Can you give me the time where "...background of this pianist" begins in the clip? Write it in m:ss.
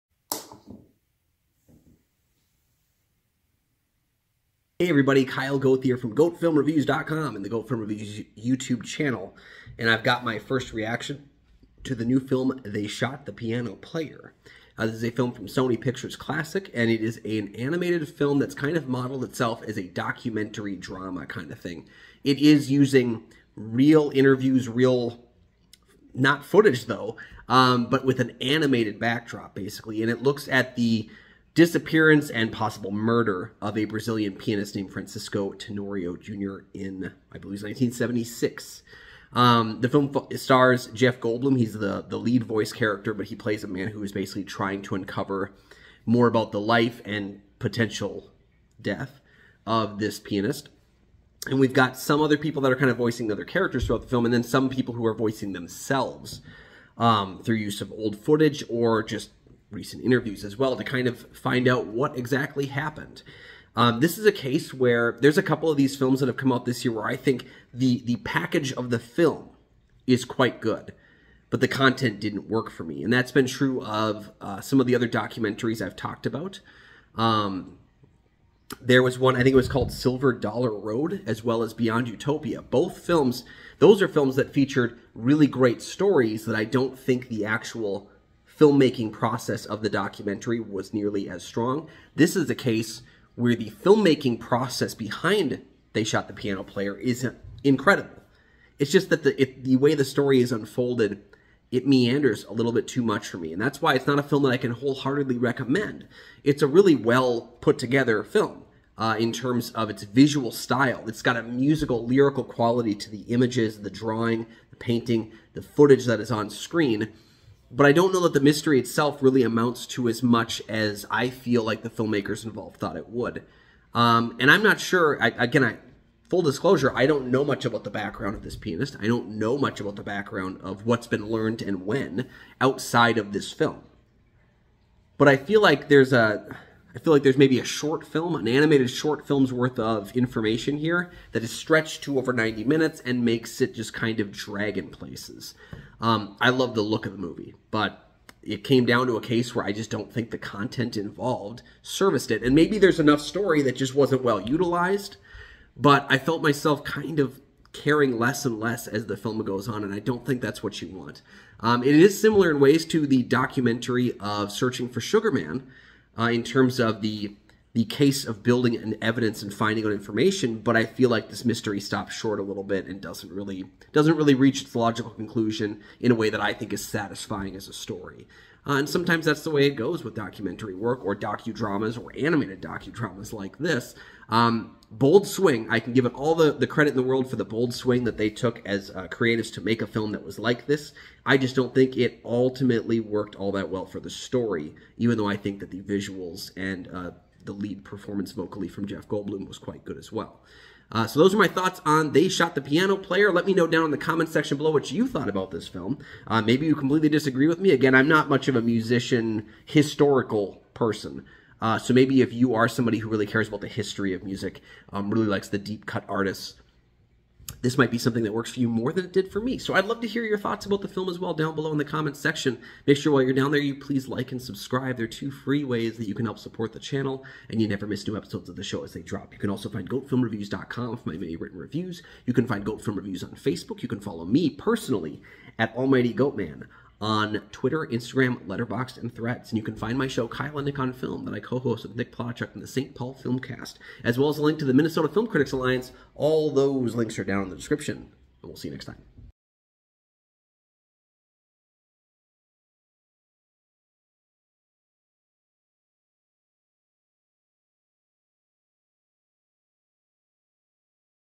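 2:07.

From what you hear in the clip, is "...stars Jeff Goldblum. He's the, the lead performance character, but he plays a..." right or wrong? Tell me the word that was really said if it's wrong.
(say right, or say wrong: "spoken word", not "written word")
wrong: "voice", not "performance".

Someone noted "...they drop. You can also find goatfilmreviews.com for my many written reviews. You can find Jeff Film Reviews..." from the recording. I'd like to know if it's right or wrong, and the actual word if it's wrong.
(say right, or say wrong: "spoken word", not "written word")
wrong: "Goat", not "Jeff".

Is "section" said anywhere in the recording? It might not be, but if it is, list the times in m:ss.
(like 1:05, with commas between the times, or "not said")
3:24, 3:42.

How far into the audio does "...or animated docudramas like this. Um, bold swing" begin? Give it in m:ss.
3:02.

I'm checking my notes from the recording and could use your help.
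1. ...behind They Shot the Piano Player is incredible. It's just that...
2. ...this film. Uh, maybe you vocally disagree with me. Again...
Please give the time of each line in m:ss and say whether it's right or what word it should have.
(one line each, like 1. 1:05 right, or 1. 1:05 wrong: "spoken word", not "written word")
1. 1:34 right
2. 3:25 wrong: "completely", not "vocally".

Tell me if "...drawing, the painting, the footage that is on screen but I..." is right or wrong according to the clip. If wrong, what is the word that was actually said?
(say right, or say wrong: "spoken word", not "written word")
right.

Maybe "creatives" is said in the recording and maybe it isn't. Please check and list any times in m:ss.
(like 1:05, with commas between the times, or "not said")
3:09.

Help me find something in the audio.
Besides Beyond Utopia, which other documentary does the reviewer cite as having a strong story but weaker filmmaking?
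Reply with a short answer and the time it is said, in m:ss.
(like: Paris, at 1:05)
Silver Dollar Road, at 1:19.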